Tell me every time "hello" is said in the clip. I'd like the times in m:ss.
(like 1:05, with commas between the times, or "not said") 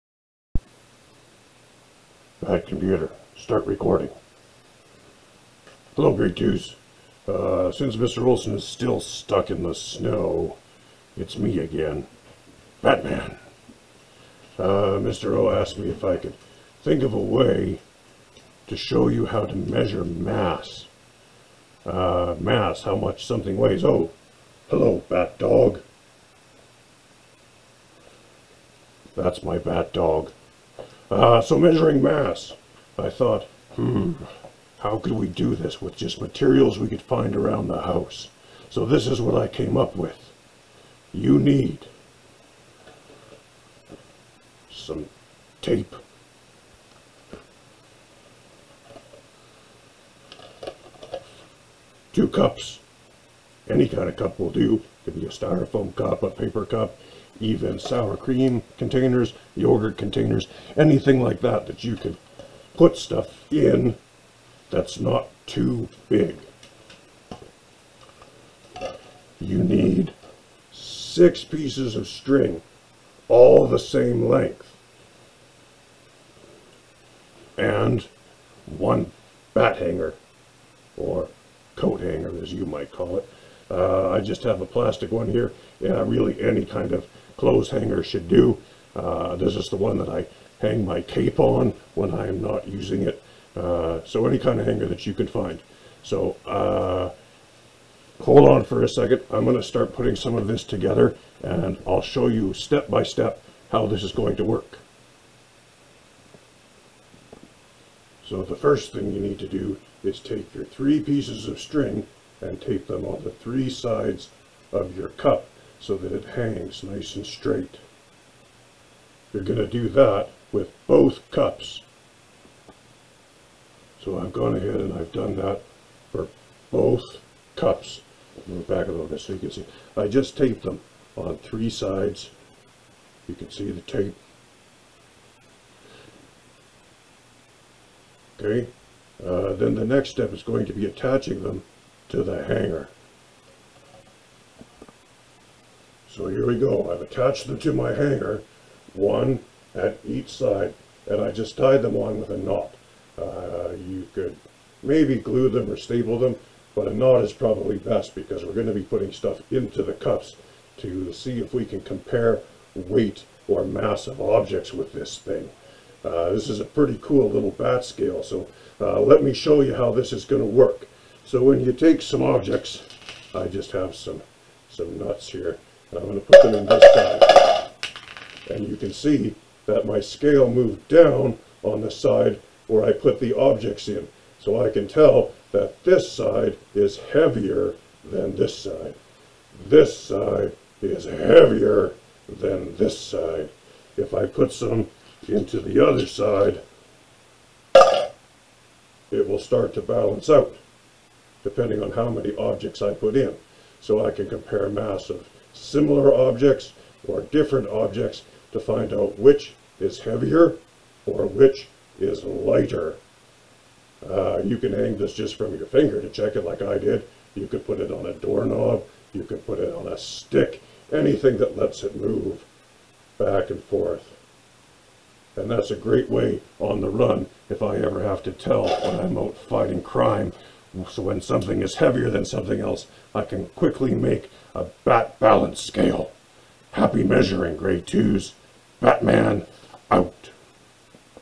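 0:05, 0:24.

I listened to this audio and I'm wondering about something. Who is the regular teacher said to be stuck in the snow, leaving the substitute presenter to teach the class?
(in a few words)
Mr. Olson.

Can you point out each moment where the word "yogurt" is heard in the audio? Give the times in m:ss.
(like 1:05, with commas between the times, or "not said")
0:59.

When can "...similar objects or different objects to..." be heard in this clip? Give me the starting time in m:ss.
3:25.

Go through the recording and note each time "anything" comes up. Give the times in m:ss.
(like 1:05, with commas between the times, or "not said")
1:00, 3:40.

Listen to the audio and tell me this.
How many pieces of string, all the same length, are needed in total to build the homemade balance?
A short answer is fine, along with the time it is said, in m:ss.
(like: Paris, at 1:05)
6, at 1:10.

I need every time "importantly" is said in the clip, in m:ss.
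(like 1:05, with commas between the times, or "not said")
not said.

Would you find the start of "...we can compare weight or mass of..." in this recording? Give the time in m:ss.
2:41.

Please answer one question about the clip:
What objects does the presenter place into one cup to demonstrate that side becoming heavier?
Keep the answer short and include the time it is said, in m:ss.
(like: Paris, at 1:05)
Nuts, at 2:54.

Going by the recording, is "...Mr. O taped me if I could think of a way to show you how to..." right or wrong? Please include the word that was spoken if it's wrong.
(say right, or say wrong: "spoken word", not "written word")
wrong: "asked", not "taped".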